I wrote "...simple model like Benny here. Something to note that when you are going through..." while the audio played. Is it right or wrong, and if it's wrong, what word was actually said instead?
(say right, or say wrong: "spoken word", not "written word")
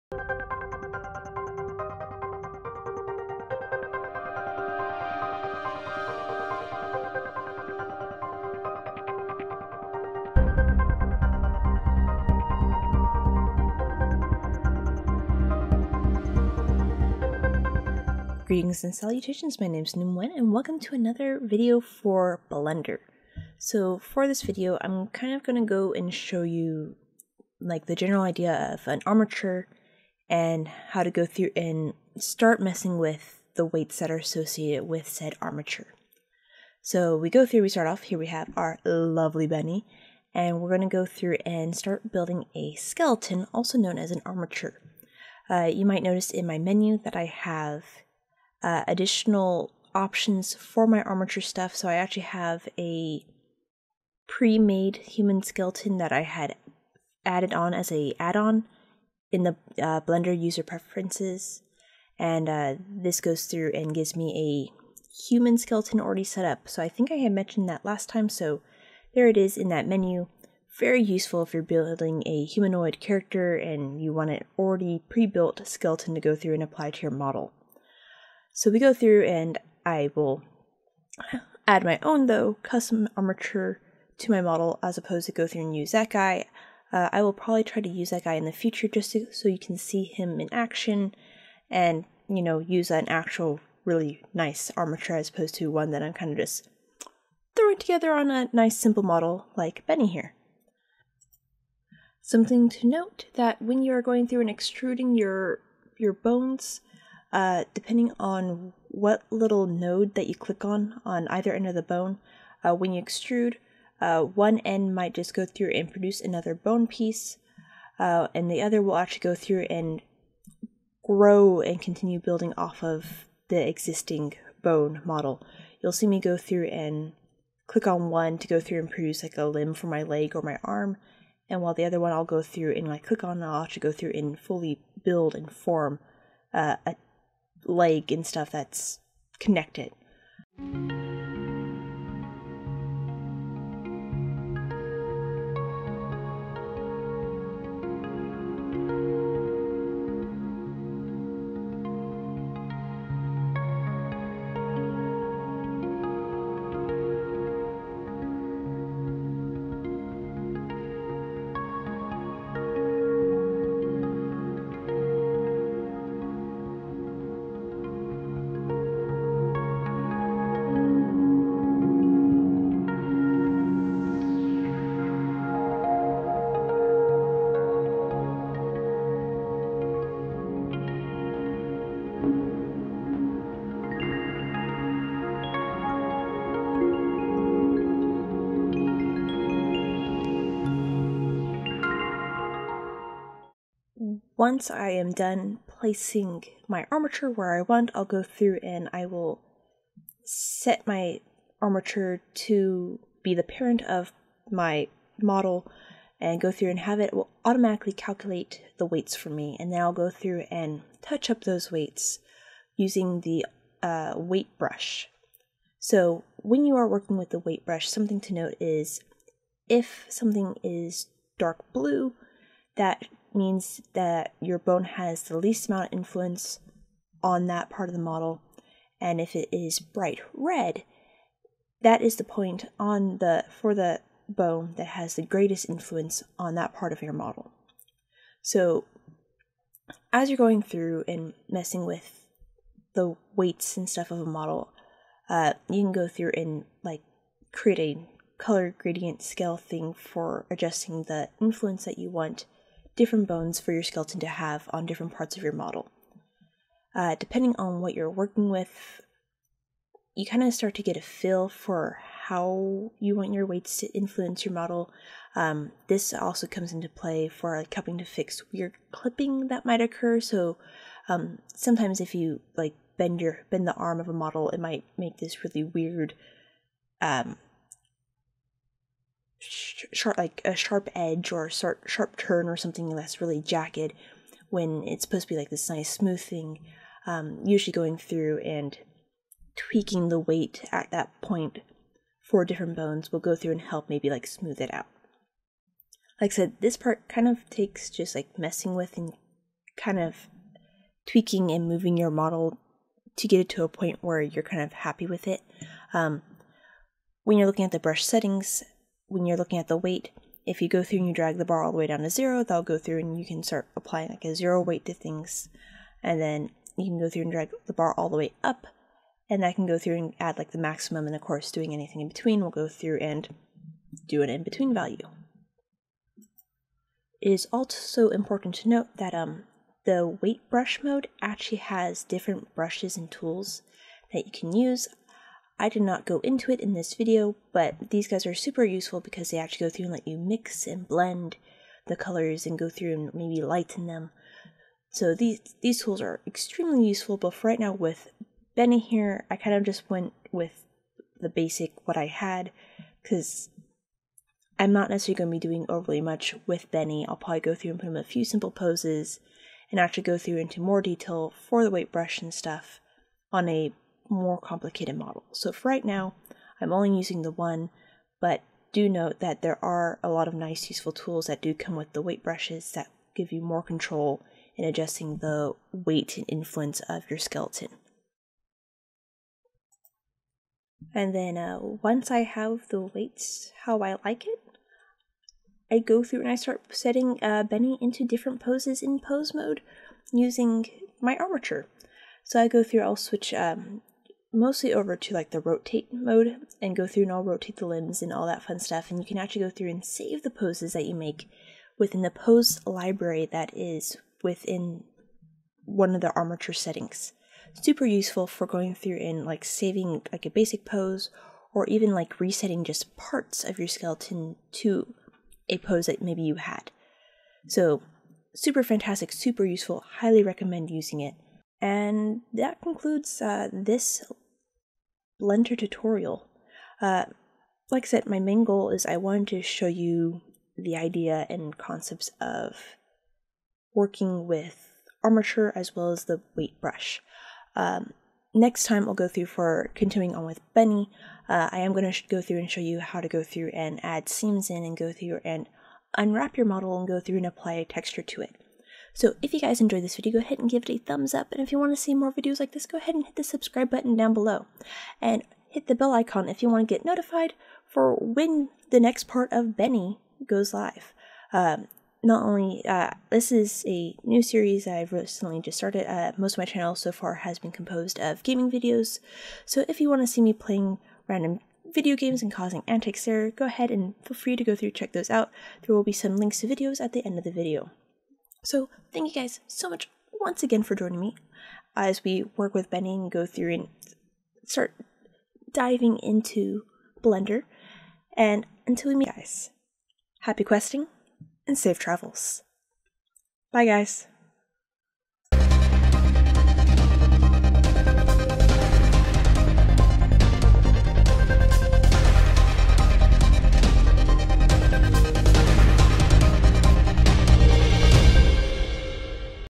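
right.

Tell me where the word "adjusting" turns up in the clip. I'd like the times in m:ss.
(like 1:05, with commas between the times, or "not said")
4:10, 6:14.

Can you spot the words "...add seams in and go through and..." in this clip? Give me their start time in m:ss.
7:23.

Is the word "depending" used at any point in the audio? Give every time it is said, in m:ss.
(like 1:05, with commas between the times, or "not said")
1:47, 4:17.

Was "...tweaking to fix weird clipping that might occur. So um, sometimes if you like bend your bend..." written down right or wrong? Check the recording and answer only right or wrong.
wrong.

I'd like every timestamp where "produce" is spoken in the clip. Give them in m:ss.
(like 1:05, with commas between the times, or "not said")
1:55, 2:08.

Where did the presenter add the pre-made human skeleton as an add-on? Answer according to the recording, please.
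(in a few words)
Blender user preferences.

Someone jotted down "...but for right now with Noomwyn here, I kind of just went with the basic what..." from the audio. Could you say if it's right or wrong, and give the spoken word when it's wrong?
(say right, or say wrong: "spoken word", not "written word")
wrong: "Benny", not "Noomwyn".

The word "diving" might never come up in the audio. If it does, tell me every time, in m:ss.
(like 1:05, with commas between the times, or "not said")
8:05.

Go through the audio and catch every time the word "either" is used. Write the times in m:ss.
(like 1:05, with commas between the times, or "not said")
1:51.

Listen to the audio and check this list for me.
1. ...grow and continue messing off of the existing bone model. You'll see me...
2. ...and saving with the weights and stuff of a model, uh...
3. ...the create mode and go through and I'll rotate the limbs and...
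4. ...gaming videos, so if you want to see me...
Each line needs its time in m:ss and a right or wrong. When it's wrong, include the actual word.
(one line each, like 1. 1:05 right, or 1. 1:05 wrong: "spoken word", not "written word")
1. 2:01 wrong: "building", not "messing"
2. 4:01 wrong: "messing", not "saving"
3. 6:35 wrong: "rotate", not "create"
4. 7:48 right.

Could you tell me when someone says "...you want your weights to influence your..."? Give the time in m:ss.
4:22.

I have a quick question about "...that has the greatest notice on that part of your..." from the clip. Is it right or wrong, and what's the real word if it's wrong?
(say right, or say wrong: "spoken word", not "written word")
wrong: "influence", not "notice".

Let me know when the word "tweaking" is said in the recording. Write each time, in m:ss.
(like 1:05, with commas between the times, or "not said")
4:49, 5:01.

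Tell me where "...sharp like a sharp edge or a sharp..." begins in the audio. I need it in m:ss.
4:39.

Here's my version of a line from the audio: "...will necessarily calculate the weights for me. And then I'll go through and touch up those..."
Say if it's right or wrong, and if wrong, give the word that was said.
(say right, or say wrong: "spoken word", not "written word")
wrong: "automatically", not "necessarily".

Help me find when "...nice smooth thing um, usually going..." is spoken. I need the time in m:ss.
4:45.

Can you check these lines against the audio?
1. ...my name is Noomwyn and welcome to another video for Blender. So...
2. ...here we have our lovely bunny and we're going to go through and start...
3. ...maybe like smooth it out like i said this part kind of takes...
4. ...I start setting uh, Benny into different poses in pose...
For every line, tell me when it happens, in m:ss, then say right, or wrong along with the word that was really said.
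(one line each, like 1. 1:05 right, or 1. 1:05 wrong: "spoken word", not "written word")
1. 0:19 right
2. 0:38 right
3. 4:53 right
4. 6:26 right.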